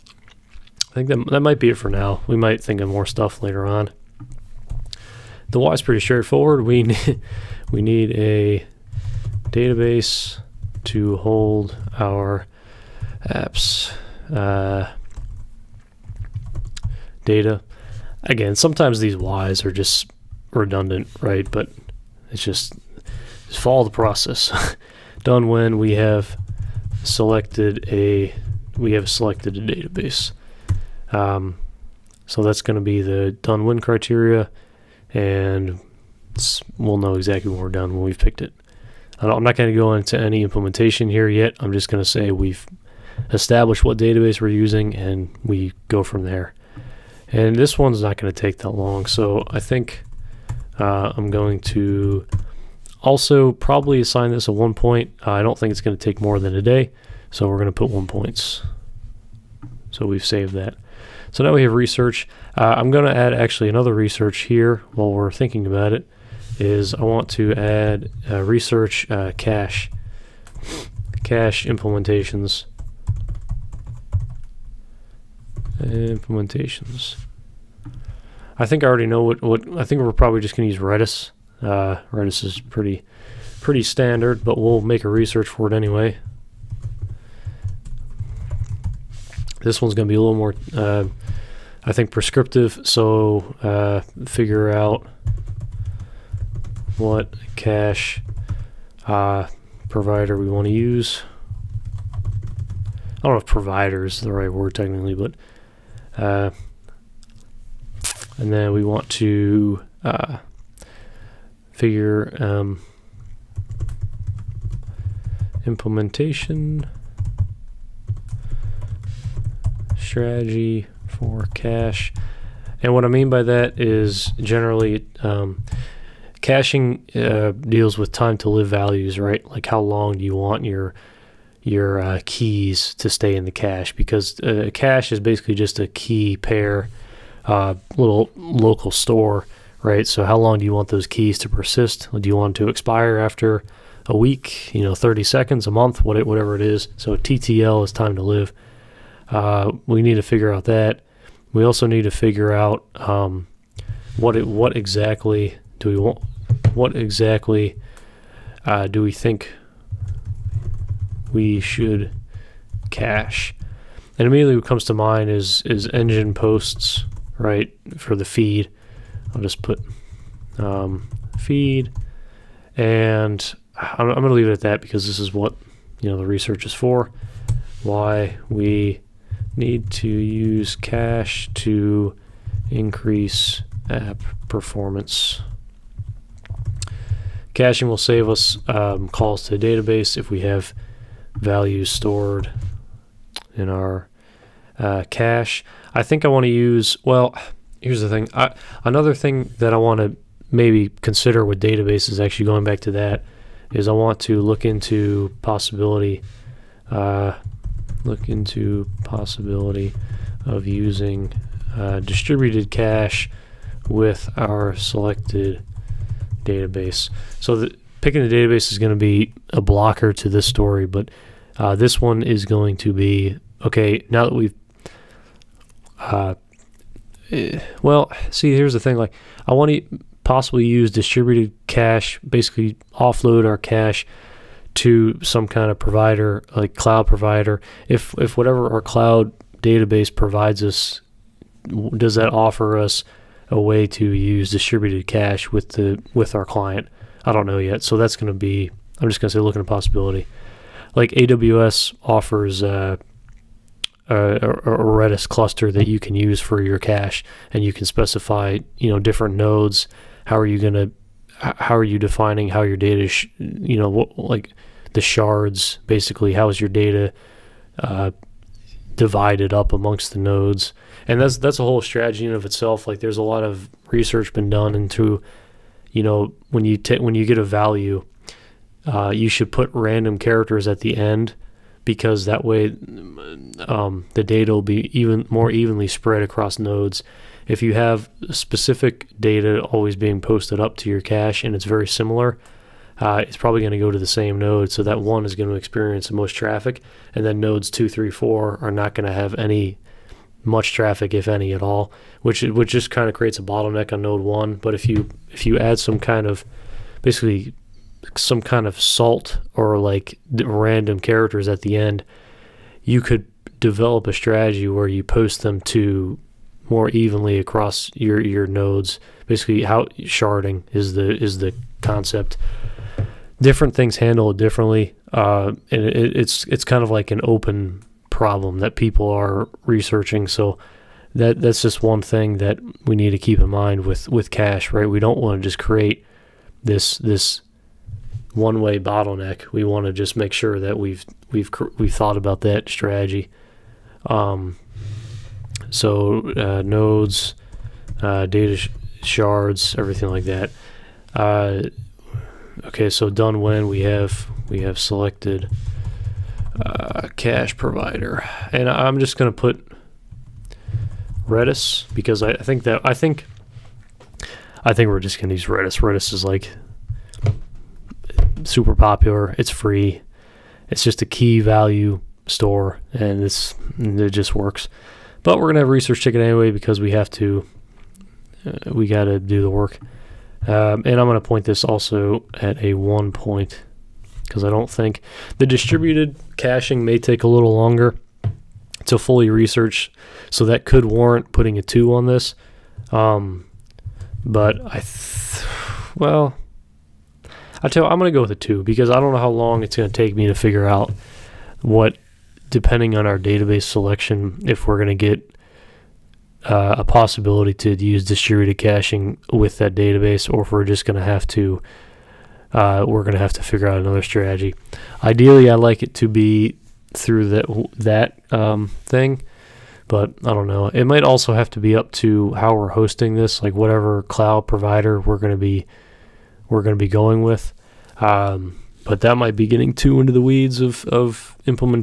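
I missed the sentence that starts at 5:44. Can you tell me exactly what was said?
Um, so uh, nodes, uh, data sh shards, everything like that.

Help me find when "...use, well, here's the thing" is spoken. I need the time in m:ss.
3:16.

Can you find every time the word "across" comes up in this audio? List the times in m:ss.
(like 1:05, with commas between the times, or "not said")
4:46, 5:17.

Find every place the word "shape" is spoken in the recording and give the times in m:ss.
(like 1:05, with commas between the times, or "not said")
not said.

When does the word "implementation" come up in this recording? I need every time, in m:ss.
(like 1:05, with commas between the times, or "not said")
0:40, 1:11, 1:15, 1:55.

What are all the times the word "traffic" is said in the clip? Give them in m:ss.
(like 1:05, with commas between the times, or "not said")
4:56, 5:00.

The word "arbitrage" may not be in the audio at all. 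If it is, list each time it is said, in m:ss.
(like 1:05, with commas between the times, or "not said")
not said.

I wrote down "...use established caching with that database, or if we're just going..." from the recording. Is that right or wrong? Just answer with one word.
wrong.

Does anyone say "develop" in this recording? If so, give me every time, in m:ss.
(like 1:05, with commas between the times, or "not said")
5:13.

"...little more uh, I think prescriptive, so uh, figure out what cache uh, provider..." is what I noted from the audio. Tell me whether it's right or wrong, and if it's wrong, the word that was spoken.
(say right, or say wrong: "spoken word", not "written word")
right.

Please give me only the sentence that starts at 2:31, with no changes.
We also need to figure out um, what it, what exactly do we want?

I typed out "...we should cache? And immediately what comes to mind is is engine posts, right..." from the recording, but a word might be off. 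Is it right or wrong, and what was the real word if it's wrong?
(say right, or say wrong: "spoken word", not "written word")
right.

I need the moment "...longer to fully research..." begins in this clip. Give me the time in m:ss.
6:27.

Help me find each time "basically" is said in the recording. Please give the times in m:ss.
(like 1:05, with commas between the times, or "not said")
2:15, 3:52, 4:25, 5:07, 5:19.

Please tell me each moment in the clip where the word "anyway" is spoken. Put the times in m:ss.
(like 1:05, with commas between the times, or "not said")
1:25, 6:16.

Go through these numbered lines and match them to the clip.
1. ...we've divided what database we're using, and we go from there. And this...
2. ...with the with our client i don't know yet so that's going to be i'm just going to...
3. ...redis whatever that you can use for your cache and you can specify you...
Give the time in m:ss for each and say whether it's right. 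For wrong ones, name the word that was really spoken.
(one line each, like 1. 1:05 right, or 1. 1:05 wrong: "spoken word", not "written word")
1. 0:42 wrong: "established", not "divided"
2. 4:05 right
3. 4:14 wrong: "cluster", not "whatever".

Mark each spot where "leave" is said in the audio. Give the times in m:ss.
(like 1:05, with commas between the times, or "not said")
2:54.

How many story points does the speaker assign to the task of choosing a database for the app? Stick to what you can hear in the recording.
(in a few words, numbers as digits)
1.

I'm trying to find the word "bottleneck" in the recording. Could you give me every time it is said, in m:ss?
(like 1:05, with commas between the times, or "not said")
5:03, 5:38.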